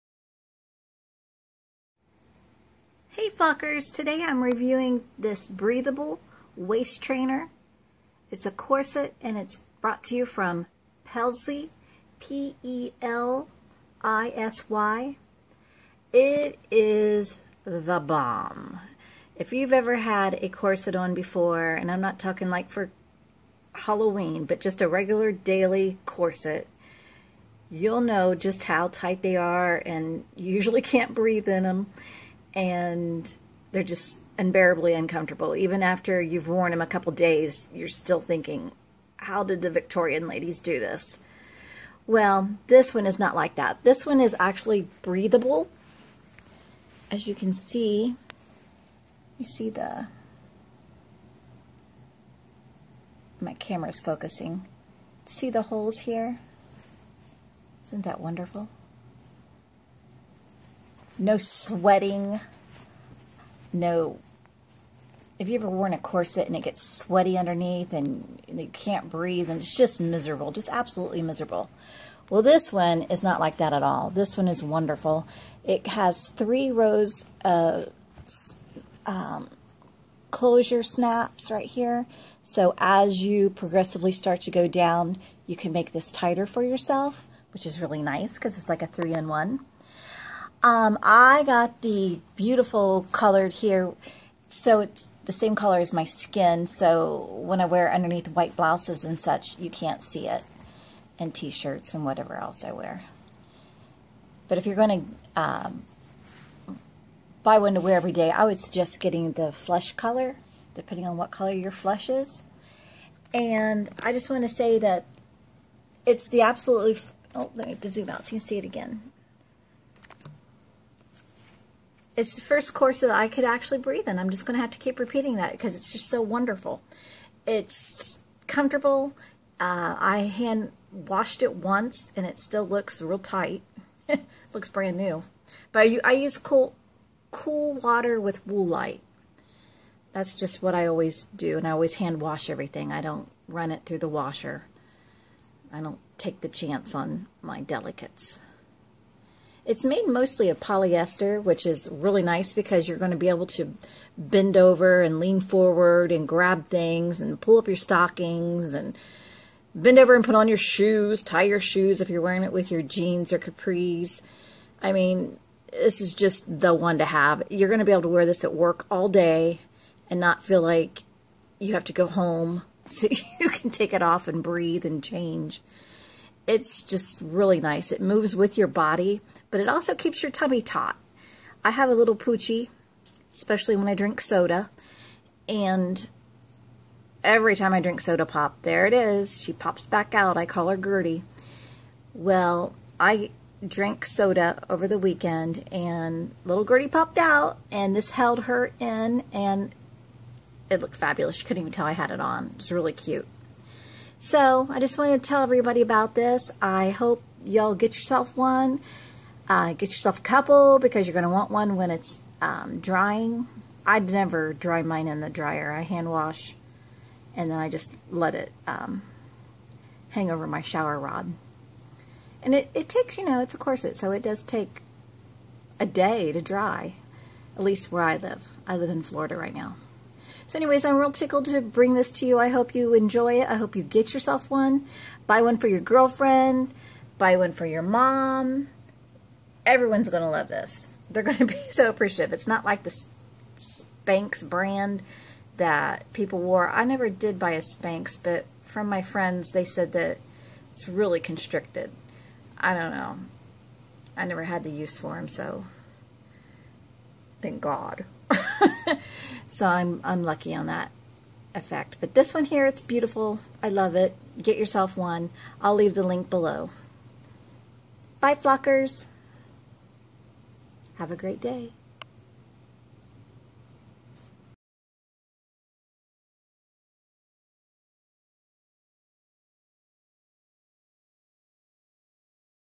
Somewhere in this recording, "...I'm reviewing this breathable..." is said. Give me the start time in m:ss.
0:04.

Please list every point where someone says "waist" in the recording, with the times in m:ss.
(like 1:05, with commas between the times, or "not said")
0:06.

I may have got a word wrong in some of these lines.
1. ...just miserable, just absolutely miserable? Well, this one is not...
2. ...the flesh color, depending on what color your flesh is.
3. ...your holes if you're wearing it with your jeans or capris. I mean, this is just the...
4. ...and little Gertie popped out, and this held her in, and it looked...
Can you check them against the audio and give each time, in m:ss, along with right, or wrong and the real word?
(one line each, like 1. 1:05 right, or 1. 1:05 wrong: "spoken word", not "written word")
1. 1:09 right
2. 1:49 right
3. 2:41 wrong: "shoes", not "holes"
4. 3:15 right.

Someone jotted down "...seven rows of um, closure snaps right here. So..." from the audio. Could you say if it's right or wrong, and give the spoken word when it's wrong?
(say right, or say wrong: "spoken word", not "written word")
wrong: "three", not "seven".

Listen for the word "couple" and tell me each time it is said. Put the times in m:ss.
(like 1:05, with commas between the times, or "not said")
0:36, 3:30.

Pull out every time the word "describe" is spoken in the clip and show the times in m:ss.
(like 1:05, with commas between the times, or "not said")
not said.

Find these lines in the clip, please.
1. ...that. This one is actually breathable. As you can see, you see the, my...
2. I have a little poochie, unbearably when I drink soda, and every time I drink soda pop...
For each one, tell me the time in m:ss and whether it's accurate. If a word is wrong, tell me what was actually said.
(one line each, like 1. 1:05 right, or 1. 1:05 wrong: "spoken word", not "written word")
1. 0:43 right
2. 3:01 wrong: "especially", not "unbearably".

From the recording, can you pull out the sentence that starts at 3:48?
I live in Florida right now.